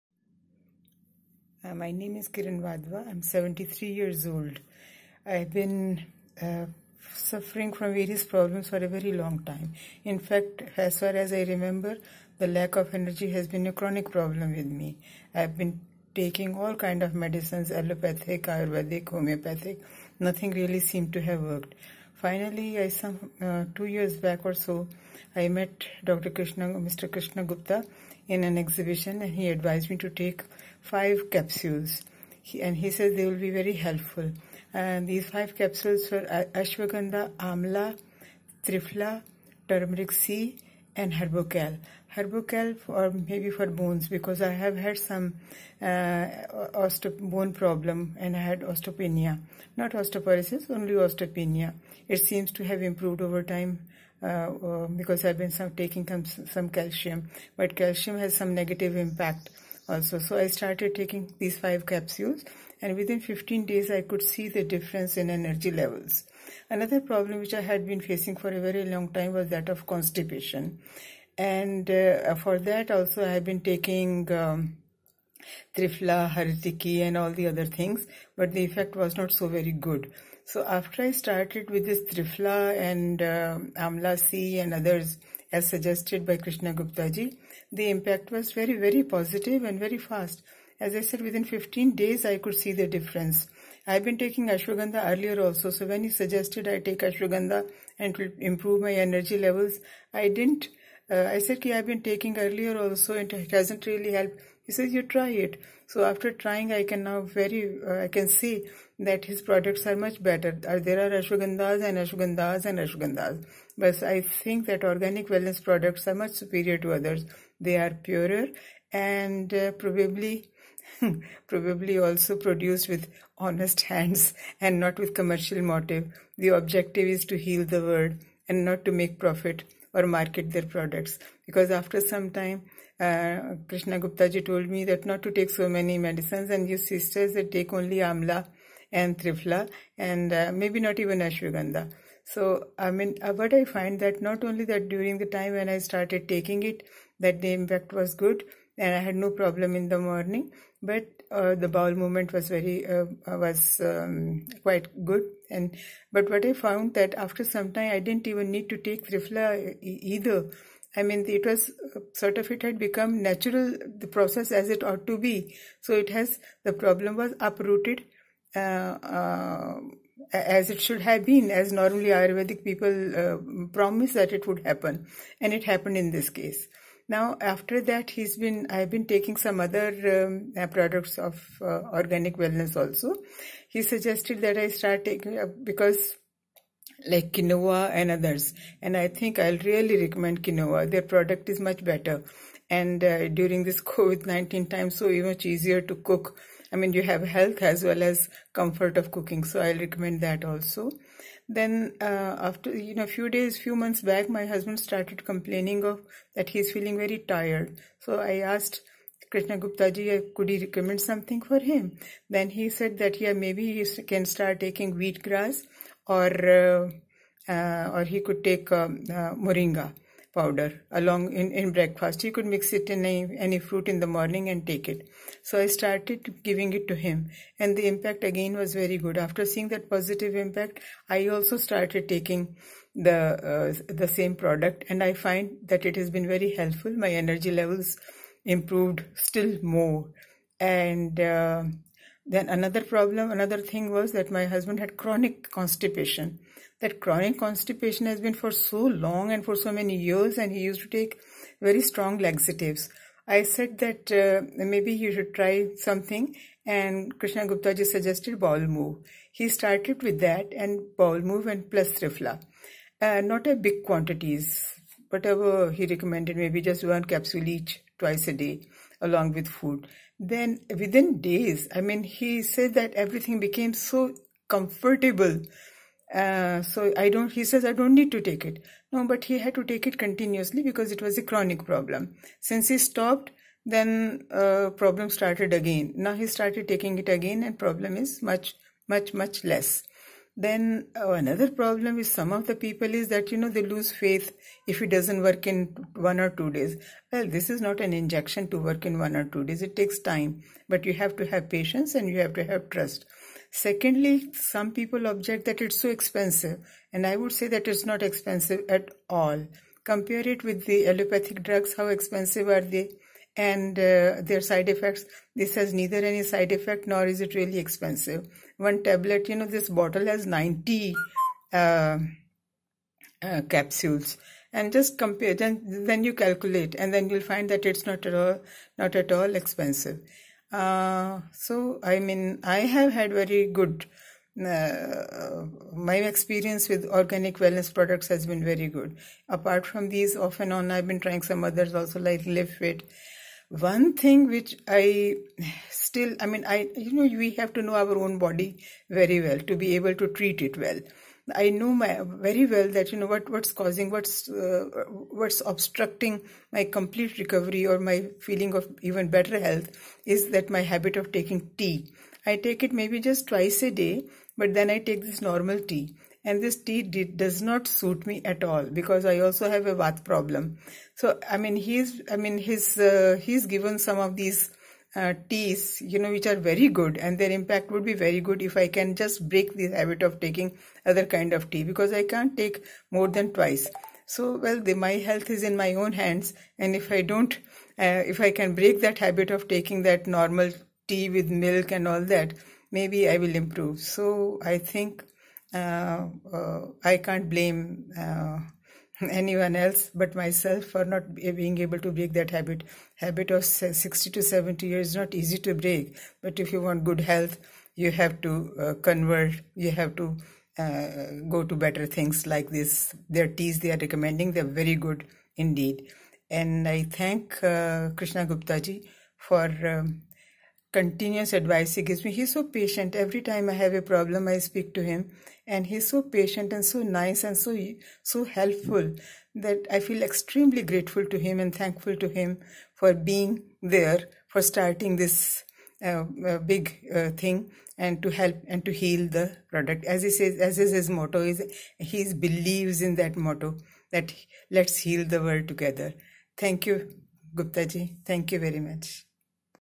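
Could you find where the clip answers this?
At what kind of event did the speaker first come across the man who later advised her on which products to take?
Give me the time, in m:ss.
0:28.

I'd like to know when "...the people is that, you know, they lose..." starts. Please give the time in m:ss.
4:52.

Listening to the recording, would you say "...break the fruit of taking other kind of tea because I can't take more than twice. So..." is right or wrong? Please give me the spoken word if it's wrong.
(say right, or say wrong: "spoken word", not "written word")
wrong: "habit", not "fruit".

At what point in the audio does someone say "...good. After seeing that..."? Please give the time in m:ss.
3:48.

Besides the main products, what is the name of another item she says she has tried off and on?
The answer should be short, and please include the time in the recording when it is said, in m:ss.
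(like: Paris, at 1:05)
Live Fit, at 5:42.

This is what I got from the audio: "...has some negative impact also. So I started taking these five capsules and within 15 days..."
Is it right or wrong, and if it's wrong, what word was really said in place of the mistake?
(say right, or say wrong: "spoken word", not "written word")
right.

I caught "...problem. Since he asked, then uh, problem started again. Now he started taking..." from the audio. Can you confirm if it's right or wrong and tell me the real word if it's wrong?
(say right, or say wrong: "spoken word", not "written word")
wrong: "stopped", not "asked".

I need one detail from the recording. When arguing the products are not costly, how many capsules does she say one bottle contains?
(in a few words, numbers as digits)
90.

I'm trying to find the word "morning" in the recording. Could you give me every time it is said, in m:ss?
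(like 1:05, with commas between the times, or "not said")
2:29, 3:44.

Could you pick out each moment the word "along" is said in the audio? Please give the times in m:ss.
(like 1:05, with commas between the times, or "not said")
3:40, 4:29.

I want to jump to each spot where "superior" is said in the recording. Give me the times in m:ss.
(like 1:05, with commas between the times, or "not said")
1:56.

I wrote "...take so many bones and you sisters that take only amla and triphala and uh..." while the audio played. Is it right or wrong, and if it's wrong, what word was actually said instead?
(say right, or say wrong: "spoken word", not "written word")
wrong: "medicines", not "bones".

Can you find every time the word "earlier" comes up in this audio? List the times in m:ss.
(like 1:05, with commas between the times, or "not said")
1:35, 1:42.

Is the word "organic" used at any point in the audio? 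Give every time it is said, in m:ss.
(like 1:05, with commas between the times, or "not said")
1:54, 3:01, 5:36.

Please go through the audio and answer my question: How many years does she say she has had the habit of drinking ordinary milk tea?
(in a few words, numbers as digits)
60 to 70.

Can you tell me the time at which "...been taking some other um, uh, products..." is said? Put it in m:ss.
2:58.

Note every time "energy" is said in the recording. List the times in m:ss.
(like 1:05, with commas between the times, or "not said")
0:12, 1:05, 1:38, 3:57.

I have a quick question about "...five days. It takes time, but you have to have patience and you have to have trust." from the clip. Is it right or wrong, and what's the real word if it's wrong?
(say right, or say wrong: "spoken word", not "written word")
wrong: "two", not "five".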